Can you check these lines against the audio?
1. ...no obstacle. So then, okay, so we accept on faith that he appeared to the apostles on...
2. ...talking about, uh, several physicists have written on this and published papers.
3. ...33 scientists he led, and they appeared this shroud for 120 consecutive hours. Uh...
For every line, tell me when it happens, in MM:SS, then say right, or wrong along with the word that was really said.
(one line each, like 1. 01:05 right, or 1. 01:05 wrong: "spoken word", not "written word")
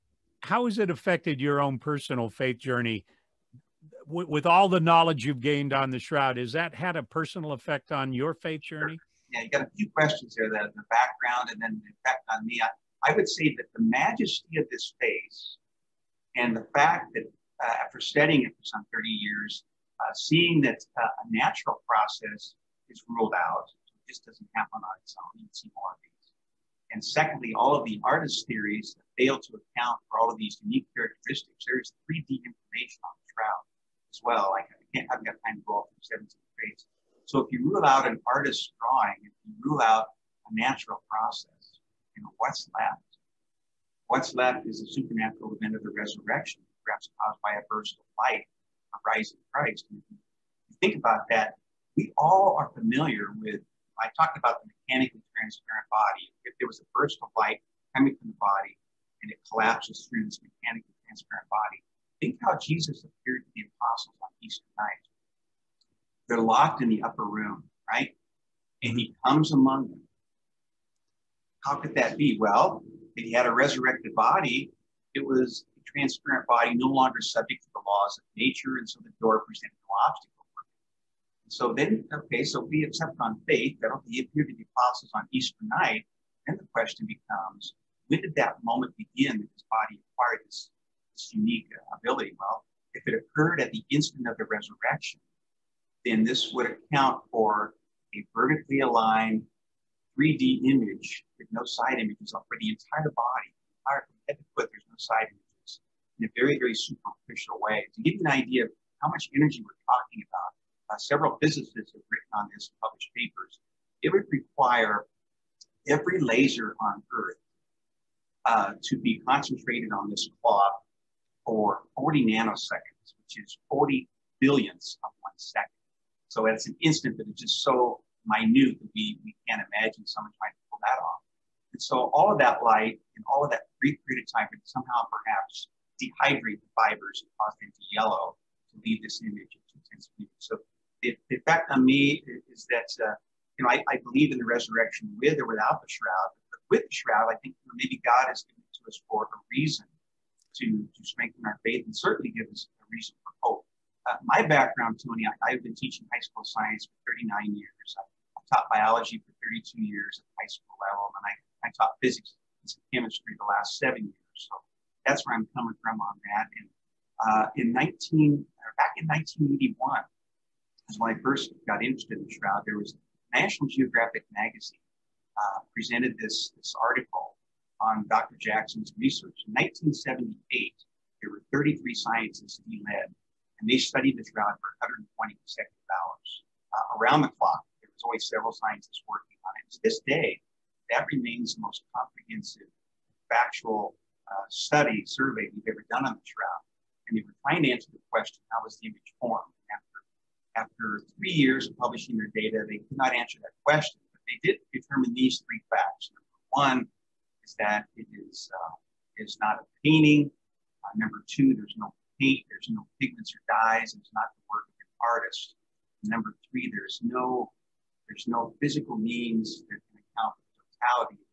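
1. 01:19 right
2. 01:49 right
3. 03:01 wrong: "studied", not "appeared".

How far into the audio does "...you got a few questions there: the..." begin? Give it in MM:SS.
00:09.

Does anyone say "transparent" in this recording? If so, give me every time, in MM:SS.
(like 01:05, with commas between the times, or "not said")
00:55, 01:01, 01:15.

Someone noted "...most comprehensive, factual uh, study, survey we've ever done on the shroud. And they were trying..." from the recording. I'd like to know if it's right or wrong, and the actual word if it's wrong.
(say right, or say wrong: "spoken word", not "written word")
right.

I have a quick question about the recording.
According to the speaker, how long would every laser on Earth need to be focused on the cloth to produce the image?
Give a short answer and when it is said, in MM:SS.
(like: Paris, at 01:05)
40 nanoseconds, at 02:01.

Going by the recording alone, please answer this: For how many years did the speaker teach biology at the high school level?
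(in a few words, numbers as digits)
32.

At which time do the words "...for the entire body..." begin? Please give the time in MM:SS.
01:42.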